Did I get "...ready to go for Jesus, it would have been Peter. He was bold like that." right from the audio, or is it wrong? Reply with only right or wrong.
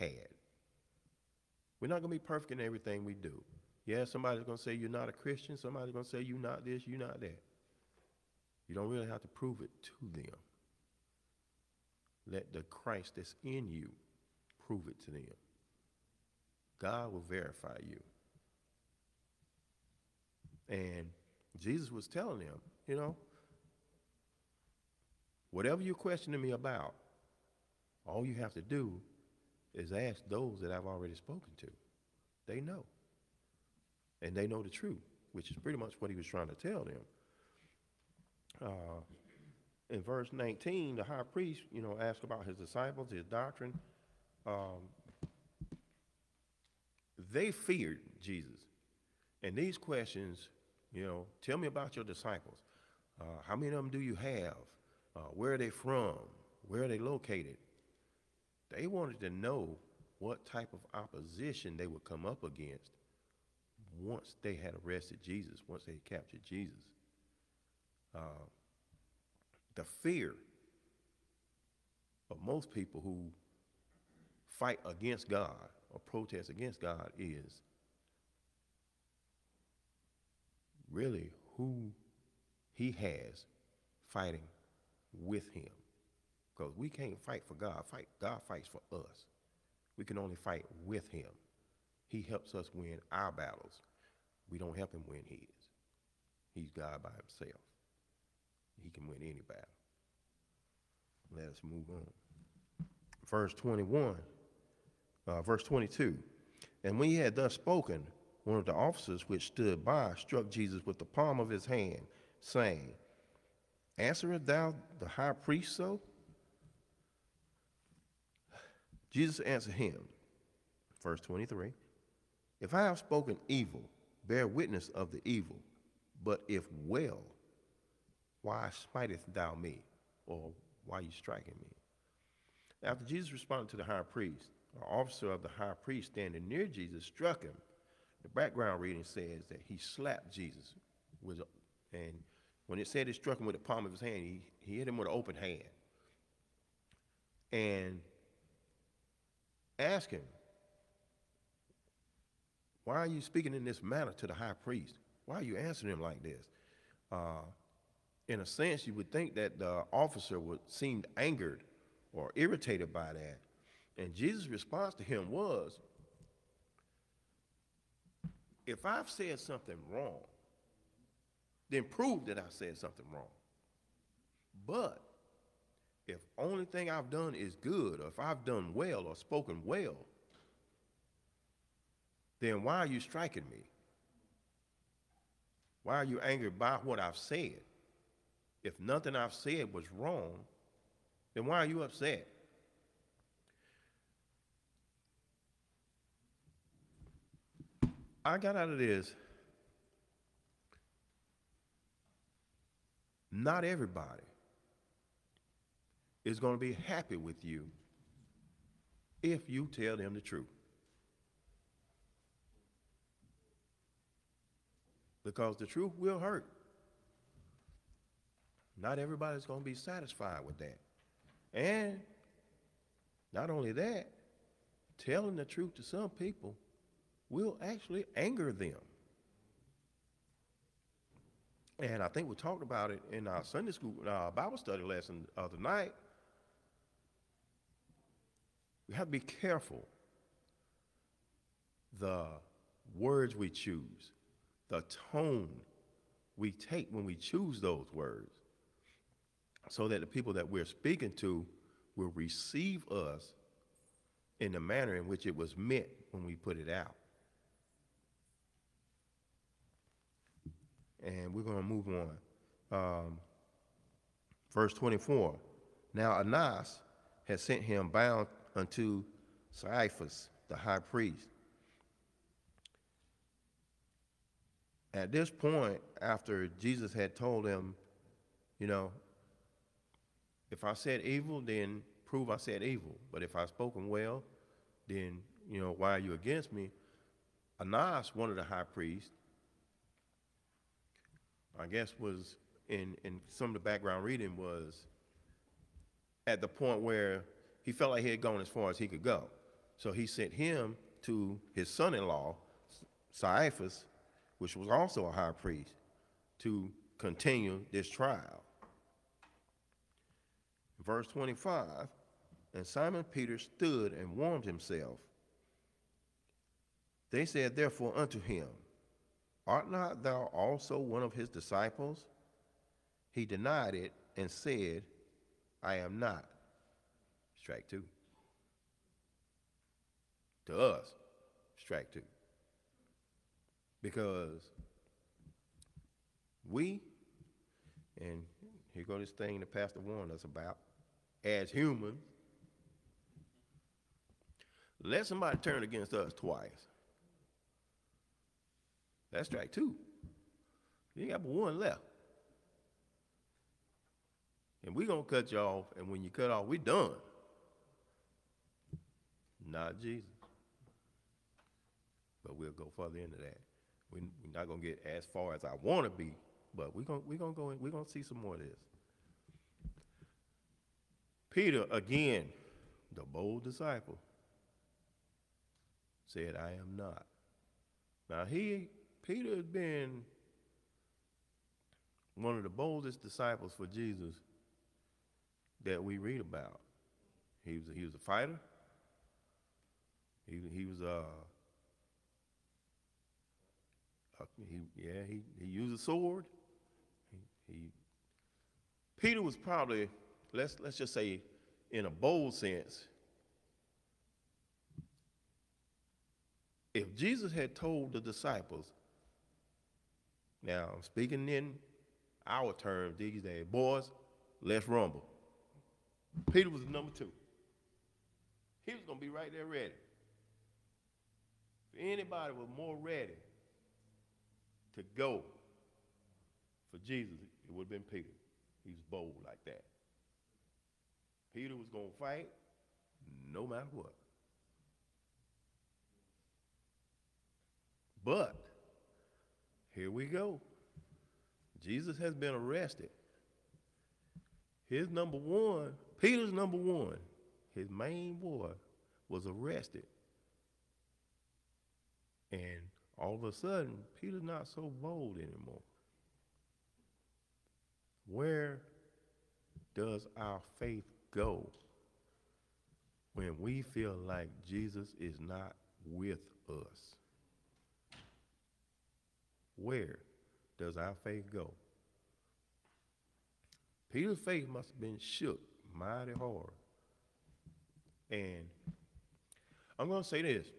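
right.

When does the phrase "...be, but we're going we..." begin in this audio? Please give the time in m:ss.
6:05.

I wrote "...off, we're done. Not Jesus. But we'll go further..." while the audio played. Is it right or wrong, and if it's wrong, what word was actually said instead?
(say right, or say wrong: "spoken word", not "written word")
right.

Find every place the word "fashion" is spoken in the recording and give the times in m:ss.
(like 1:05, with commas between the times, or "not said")
not said.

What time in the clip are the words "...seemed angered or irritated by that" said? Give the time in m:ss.
2:40.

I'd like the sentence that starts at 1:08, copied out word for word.
Uh, the fear of most people who fight against God or protest against God is really who he has fighting with him.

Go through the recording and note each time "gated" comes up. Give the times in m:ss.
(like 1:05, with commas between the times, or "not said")
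not said.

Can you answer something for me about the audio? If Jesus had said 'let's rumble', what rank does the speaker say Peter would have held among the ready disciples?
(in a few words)
Number two.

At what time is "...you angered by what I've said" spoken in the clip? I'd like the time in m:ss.
3:06.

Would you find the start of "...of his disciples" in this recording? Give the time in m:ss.
5:21.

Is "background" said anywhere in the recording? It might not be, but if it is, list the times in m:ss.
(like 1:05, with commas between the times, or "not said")
2:18, 4:53.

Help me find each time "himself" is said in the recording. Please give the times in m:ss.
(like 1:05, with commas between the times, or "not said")
1:37, 5:14.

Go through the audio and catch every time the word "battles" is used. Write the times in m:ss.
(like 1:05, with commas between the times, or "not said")
1:33, 1:39.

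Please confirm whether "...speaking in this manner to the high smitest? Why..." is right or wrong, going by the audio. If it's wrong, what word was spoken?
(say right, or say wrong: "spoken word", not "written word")
wrong: "priest", not "smitest".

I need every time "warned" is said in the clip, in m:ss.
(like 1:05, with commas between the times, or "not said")
5:39.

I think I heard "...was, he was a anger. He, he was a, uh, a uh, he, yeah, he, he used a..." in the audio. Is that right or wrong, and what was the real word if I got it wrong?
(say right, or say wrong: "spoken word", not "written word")
wrong: "fighter", not "anger".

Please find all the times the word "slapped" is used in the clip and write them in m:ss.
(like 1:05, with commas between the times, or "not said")
2:19.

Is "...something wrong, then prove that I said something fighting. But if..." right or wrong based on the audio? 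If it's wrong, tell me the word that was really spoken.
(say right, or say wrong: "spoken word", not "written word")
wrong: "wrong", not "fighting".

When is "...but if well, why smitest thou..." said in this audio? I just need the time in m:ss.
2:06.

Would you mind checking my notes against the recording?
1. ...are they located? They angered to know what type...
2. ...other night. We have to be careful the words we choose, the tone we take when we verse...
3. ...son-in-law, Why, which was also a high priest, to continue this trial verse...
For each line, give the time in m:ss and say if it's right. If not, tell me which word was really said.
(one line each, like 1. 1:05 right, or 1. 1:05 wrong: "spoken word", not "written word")
1. 0:56 wrong: "wanted", not "angered"
2. 3:55 wrong: "choose", not "verse"
3. 5:01 wrong: "Caiaphas", not "Why".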